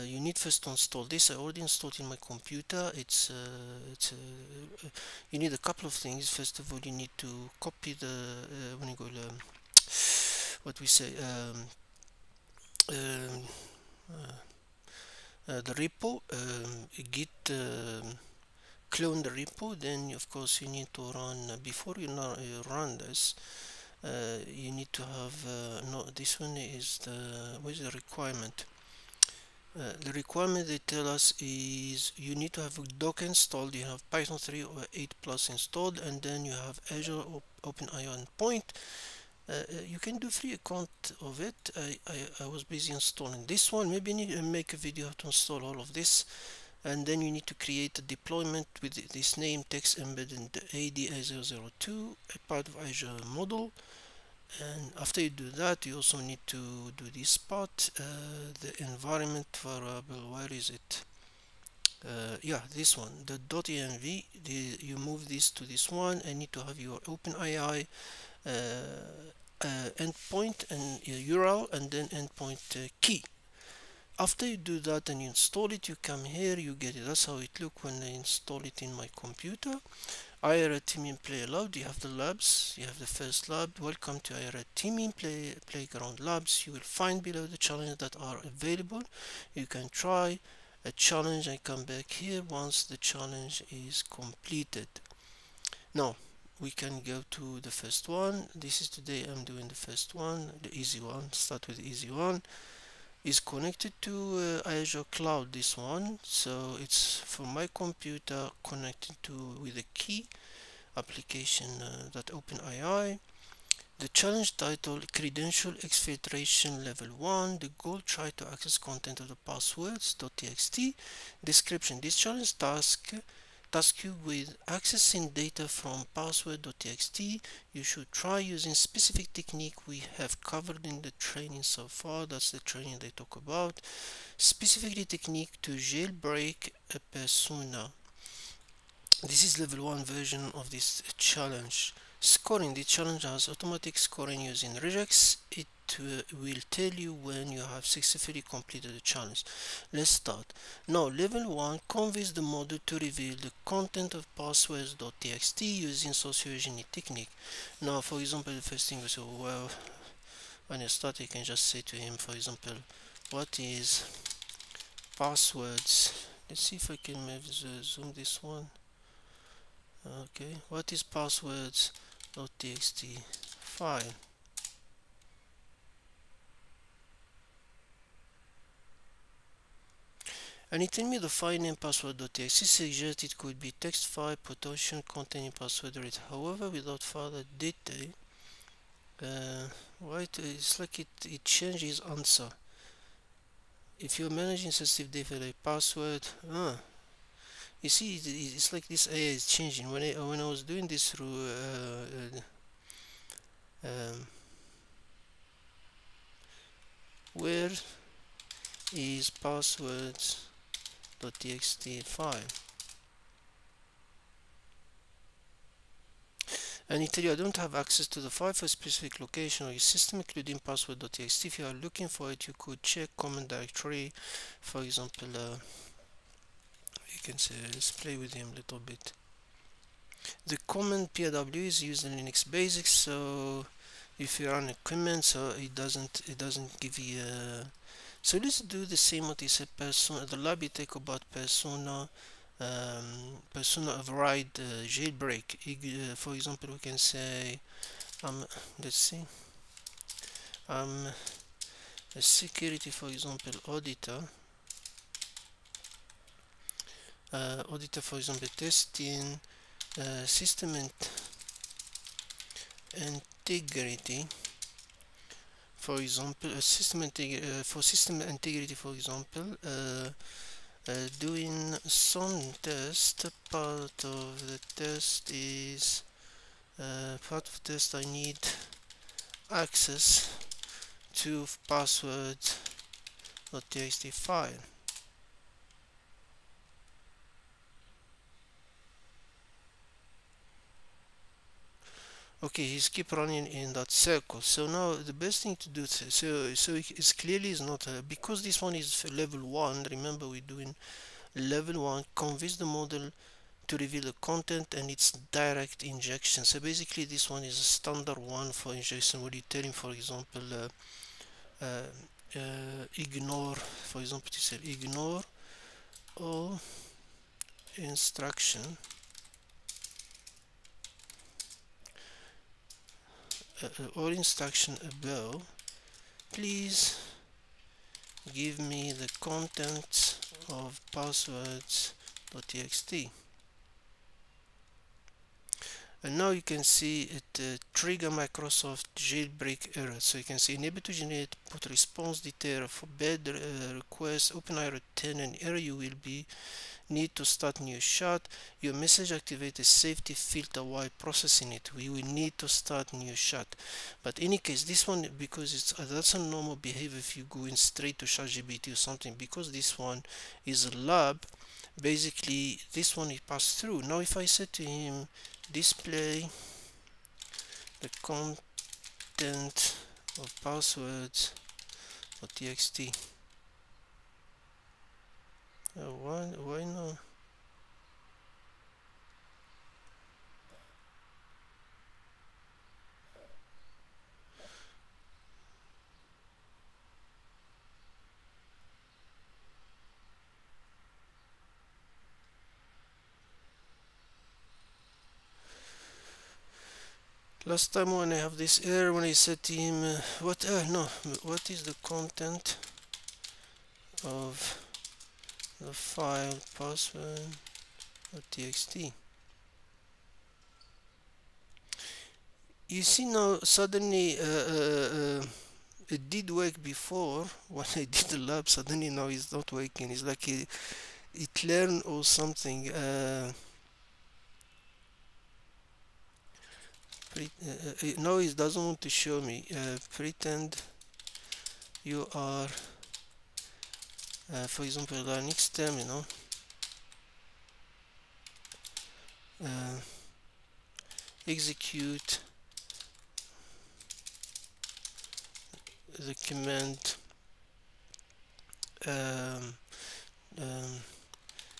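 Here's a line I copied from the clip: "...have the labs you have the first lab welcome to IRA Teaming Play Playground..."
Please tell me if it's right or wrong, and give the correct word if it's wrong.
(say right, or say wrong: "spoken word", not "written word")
right.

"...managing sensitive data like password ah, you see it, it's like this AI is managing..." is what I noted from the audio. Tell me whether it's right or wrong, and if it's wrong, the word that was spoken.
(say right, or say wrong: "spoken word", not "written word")
wrong: "changing", not "managing".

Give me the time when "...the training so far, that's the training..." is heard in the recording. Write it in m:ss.
2:11.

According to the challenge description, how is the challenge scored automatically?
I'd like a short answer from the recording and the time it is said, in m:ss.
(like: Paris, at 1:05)
Using regex, at 2:24.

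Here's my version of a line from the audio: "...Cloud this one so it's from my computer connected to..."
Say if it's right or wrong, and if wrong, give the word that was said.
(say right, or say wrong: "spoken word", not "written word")
right.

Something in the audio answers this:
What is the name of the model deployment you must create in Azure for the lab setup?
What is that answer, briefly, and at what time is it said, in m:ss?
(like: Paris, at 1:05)
text embedding ada 2, at 0:49.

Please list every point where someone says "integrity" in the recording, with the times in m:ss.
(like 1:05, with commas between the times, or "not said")
4:22, 4:28.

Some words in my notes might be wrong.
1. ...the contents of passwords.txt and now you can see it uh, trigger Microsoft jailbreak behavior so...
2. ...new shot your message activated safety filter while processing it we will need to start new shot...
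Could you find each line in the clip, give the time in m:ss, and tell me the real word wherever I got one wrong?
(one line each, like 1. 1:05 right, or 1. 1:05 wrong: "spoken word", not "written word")
1. 5:28 wrong: "error", not "behavior"
2. 5:47 right.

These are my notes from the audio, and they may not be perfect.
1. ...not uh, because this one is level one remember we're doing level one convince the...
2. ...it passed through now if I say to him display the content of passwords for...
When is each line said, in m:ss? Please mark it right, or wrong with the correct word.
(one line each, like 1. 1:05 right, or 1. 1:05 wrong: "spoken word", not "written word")
1. 4:57 right
2. 6:03 right.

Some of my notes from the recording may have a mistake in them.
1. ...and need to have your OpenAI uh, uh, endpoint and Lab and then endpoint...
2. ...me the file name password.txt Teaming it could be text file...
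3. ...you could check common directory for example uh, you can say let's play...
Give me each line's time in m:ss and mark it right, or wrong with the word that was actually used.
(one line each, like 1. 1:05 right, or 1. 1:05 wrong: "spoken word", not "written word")
1. 1:06 wrong: "URL", not "Lab"
2. 3:01 wrong: "Suggest", not "Teaming"
3. 3:42 right.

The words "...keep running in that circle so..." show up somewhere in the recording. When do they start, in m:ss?
4:52.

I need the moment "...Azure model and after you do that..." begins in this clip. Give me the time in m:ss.
0:52.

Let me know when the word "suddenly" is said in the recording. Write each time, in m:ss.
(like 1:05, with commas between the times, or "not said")
6:53, 6:58.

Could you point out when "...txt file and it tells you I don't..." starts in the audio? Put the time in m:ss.
3:31.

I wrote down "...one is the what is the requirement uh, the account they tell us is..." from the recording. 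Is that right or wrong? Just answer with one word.
wrong.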